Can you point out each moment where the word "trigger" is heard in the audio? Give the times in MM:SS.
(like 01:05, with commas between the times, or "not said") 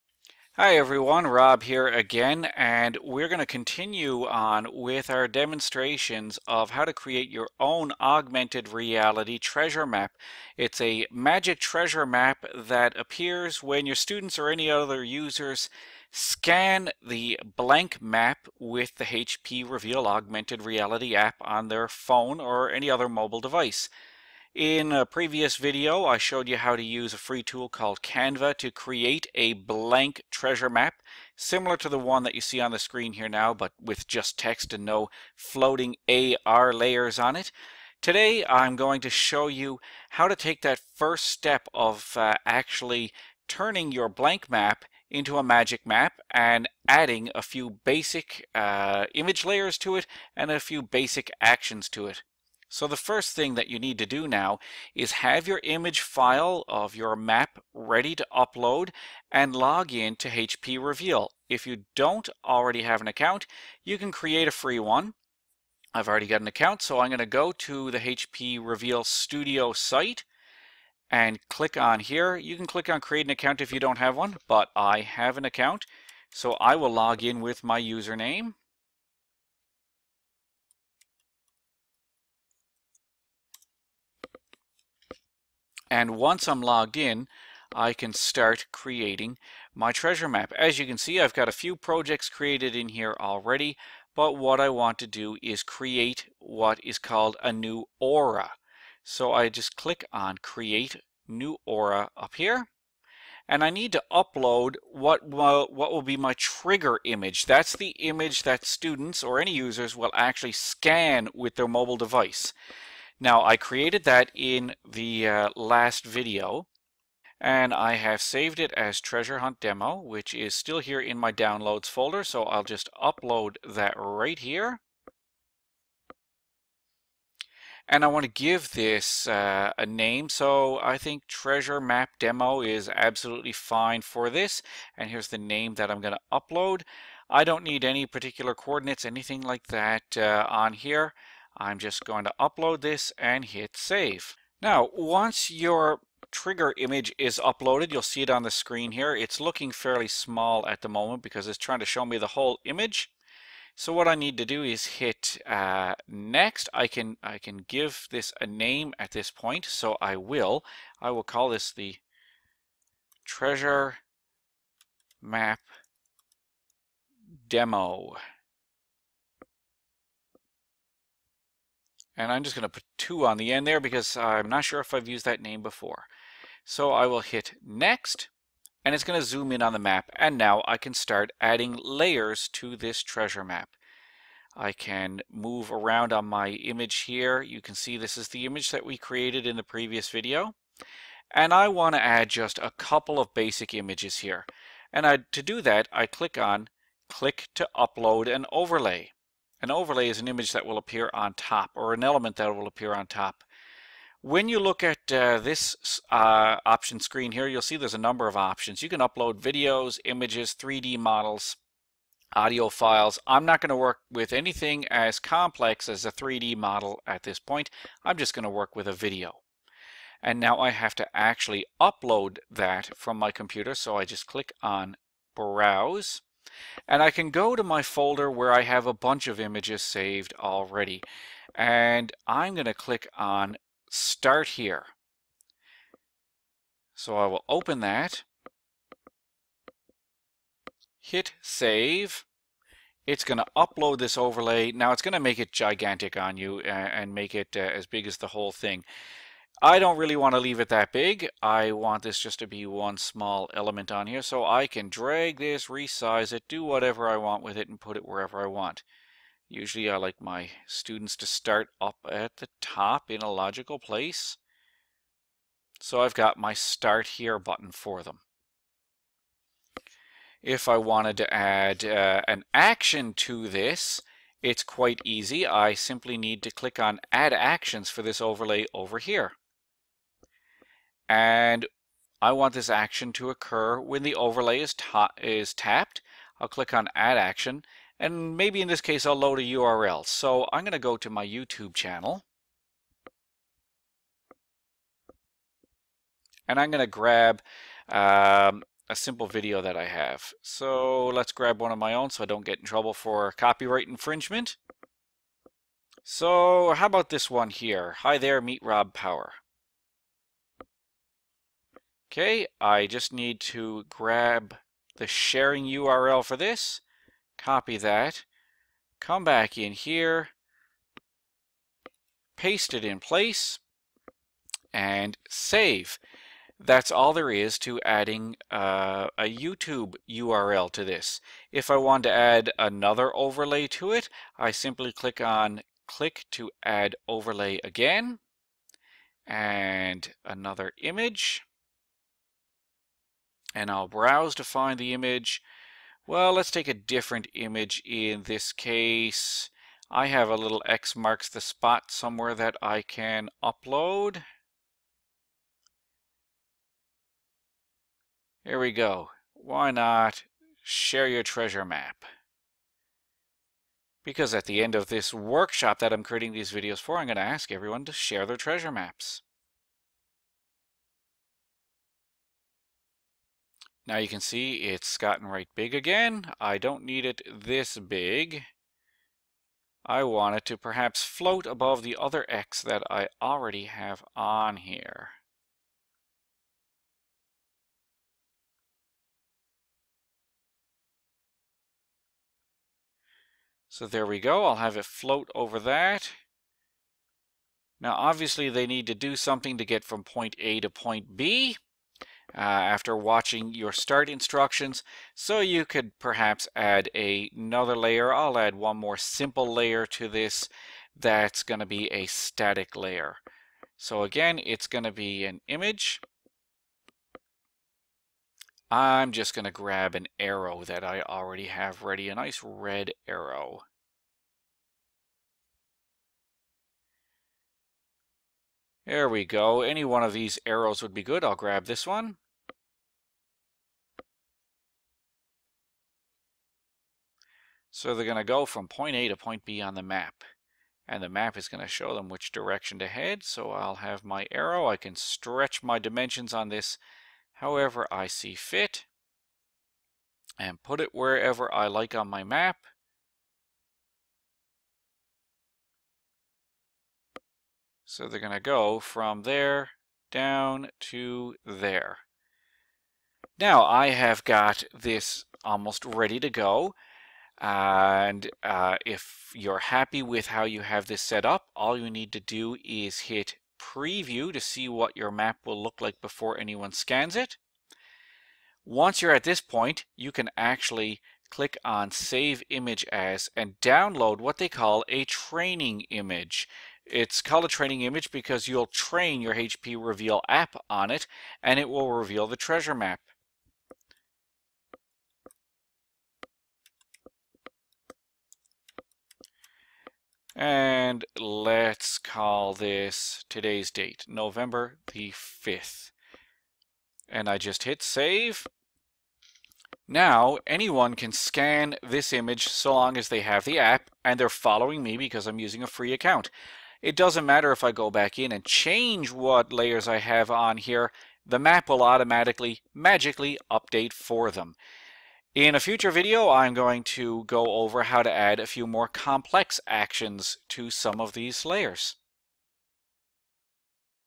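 01:46, 02:26.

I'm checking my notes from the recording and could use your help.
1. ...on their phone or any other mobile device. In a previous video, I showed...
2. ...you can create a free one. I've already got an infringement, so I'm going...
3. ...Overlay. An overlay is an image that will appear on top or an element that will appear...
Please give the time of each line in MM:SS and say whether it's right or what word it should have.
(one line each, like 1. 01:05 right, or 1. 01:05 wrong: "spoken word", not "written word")
1. 00:21 right
2. 01:03 wrong: "account", not "infringement"
3. 03:18 right.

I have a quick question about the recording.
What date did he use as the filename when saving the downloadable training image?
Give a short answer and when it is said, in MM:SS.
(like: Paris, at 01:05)
November 5th, at 08:24.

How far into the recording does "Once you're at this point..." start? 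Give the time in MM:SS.
07:58.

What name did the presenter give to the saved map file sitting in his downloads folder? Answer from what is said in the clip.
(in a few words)
treasure hunt demo.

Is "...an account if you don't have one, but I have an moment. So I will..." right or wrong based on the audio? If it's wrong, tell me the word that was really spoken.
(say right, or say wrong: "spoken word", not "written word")
wrong: "account", not "moment".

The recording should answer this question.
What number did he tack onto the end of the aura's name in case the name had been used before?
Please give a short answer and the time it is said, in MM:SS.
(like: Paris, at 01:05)
2, at 02:52.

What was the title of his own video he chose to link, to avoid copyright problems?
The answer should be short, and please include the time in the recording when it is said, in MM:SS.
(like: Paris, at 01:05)
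Meet Rob Power, at 05:08.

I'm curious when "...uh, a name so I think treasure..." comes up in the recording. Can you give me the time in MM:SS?
02:09.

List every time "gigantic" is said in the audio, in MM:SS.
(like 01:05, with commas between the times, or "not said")
04:05.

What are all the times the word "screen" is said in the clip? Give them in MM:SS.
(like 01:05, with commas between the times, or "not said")
00:32, 02:28, 03:26.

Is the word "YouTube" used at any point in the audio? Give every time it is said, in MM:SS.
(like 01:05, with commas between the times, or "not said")
04:51, 05:29.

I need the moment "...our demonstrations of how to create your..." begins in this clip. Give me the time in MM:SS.
00:05.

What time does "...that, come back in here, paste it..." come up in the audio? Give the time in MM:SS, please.
05:17.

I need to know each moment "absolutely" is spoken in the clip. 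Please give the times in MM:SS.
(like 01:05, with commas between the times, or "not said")
02:12.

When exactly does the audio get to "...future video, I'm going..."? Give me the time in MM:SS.
08:45.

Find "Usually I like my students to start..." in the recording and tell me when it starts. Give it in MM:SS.
04:19.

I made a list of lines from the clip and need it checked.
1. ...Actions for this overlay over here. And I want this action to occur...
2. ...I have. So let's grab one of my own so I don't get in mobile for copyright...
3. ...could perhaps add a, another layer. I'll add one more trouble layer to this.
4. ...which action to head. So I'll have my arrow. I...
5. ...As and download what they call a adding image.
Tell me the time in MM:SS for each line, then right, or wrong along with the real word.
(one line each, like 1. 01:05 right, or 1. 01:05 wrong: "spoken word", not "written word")
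1. 04:37 right
2. 04:59 wrong: "trouble", not "mobile"
3. 06:45 wrong: "simple", not "trouble"
4. 07:22 wrong: "direction", not "action"
5. 08:02 wrong: "training", not "adding".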